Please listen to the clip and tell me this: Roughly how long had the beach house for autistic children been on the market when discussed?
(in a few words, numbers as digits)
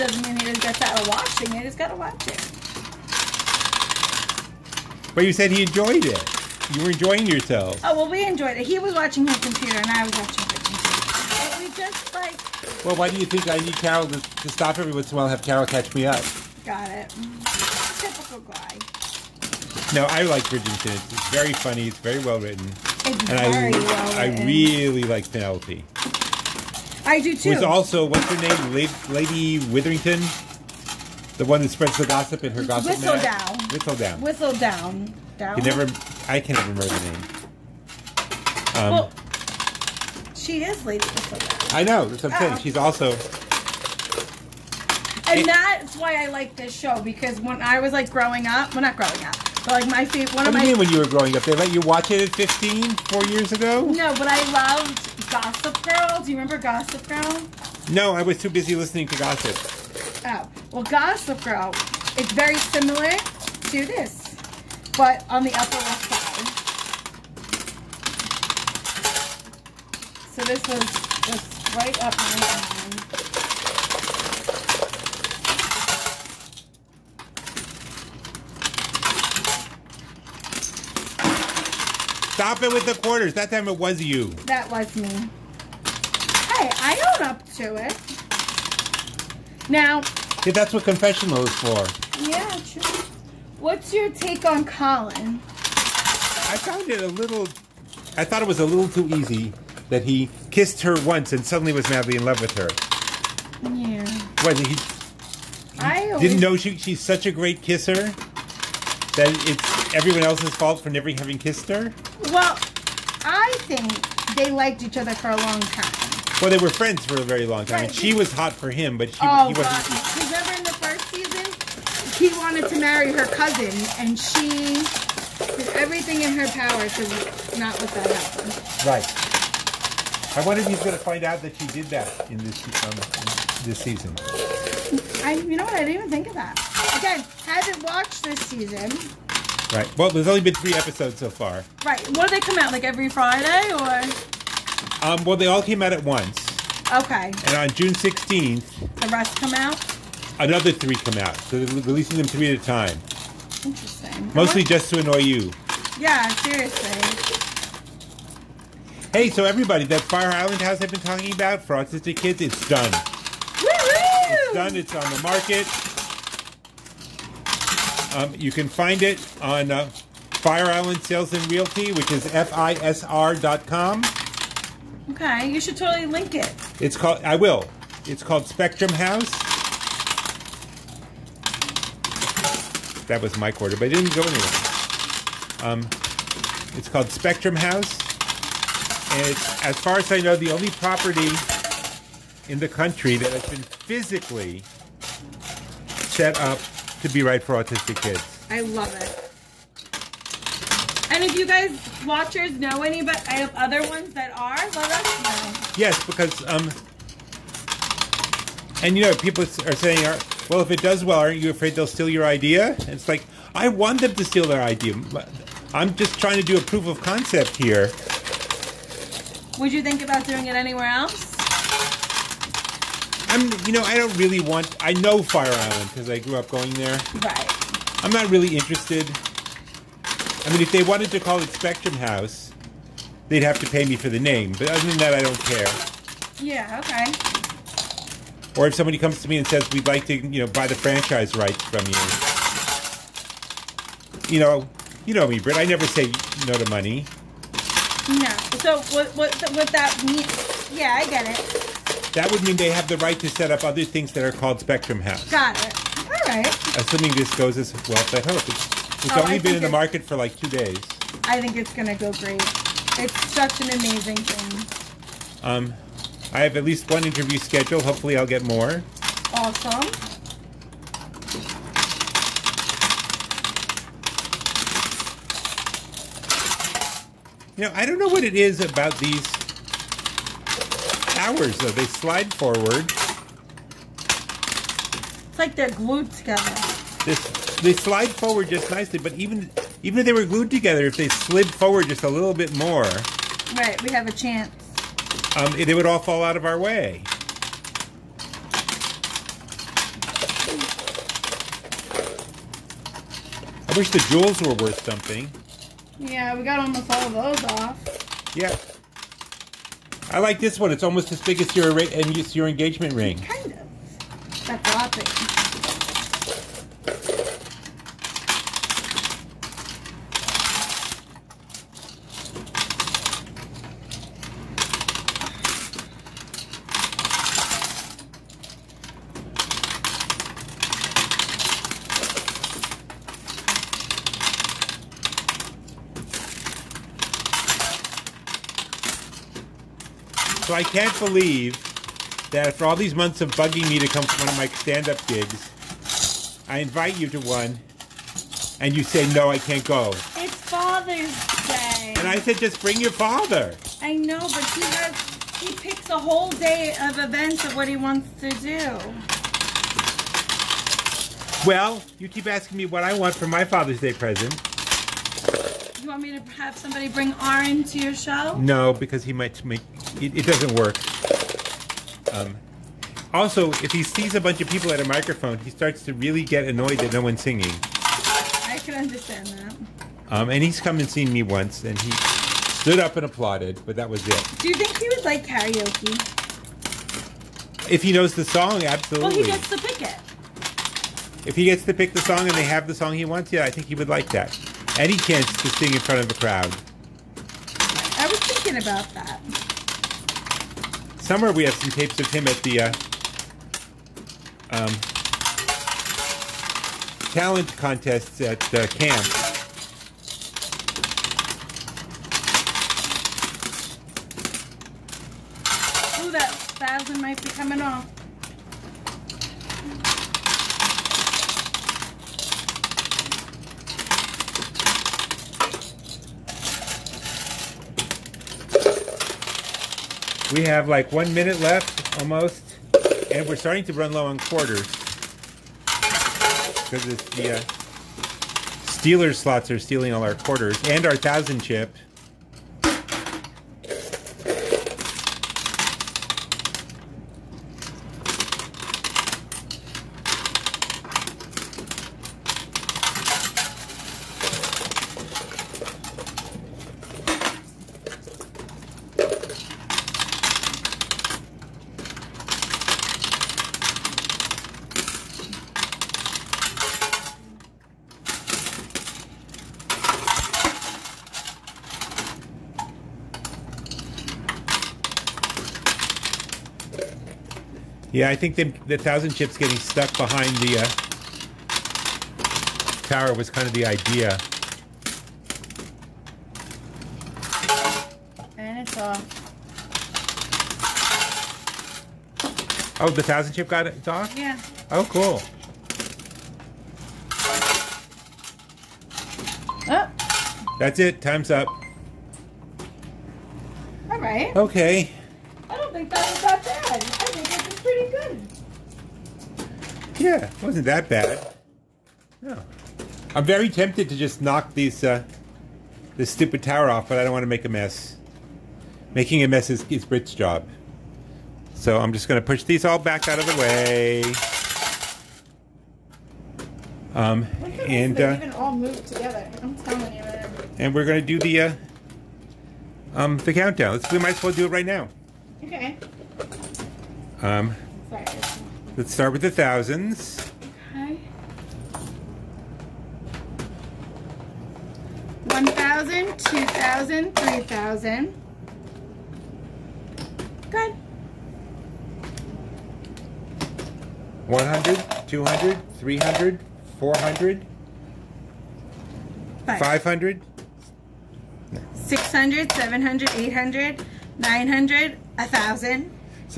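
2 days.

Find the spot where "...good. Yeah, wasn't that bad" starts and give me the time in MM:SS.
08:27.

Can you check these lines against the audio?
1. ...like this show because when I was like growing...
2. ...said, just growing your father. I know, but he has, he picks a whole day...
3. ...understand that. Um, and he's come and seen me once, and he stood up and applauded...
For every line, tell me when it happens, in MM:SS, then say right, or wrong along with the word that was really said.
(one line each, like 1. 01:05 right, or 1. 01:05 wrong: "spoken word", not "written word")
1. 00:46 right
2. 05:52 wrong: "bring", not "growing"
3. 06:18 right.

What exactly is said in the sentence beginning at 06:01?
Well, you keep asking me what I want for my Father's Day present.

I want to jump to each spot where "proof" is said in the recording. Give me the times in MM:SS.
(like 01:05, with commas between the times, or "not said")
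03:36.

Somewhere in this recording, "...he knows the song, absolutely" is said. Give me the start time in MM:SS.
06:27.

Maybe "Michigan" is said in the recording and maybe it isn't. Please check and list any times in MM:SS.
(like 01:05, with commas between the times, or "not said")
not said.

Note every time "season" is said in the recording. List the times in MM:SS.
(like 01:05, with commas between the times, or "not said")
02:01, 02:13, 02:18.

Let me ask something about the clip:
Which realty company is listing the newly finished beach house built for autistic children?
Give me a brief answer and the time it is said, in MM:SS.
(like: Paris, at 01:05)
Fire Island Sales and Realty, at 02:50.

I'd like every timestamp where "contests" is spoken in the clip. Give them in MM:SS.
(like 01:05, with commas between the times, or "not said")
06:47.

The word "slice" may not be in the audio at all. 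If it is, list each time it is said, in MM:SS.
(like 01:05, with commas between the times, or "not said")
not said.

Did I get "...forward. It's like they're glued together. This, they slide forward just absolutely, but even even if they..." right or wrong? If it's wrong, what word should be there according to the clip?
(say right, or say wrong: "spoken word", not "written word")
wrong: "nicely", not "absolutely".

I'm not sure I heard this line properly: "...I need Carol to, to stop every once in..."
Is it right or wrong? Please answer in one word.
right.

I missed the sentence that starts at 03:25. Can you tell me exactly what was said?
Yes, because um, and you know people are saying, well, if it does well, aren't you afraid they'll steal your idea?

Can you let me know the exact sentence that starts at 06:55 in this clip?
Ooh, that spasm might be coming off.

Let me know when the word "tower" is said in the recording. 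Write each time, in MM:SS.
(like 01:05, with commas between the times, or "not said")
04:41, 08:02, 08:36.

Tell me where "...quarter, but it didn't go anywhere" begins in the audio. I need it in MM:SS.
03:03.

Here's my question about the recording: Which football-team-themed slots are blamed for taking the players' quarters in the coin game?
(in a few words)
Steelers.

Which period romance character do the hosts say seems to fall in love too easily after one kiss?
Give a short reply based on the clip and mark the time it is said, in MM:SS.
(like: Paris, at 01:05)
Colin, at 01:34.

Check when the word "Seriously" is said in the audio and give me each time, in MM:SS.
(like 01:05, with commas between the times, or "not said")
02:36.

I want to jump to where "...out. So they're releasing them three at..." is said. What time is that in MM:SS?
02:31.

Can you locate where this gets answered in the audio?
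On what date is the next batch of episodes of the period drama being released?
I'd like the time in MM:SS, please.
02:27.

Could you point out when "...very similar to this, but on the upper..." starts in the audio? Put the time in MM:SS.
01:02.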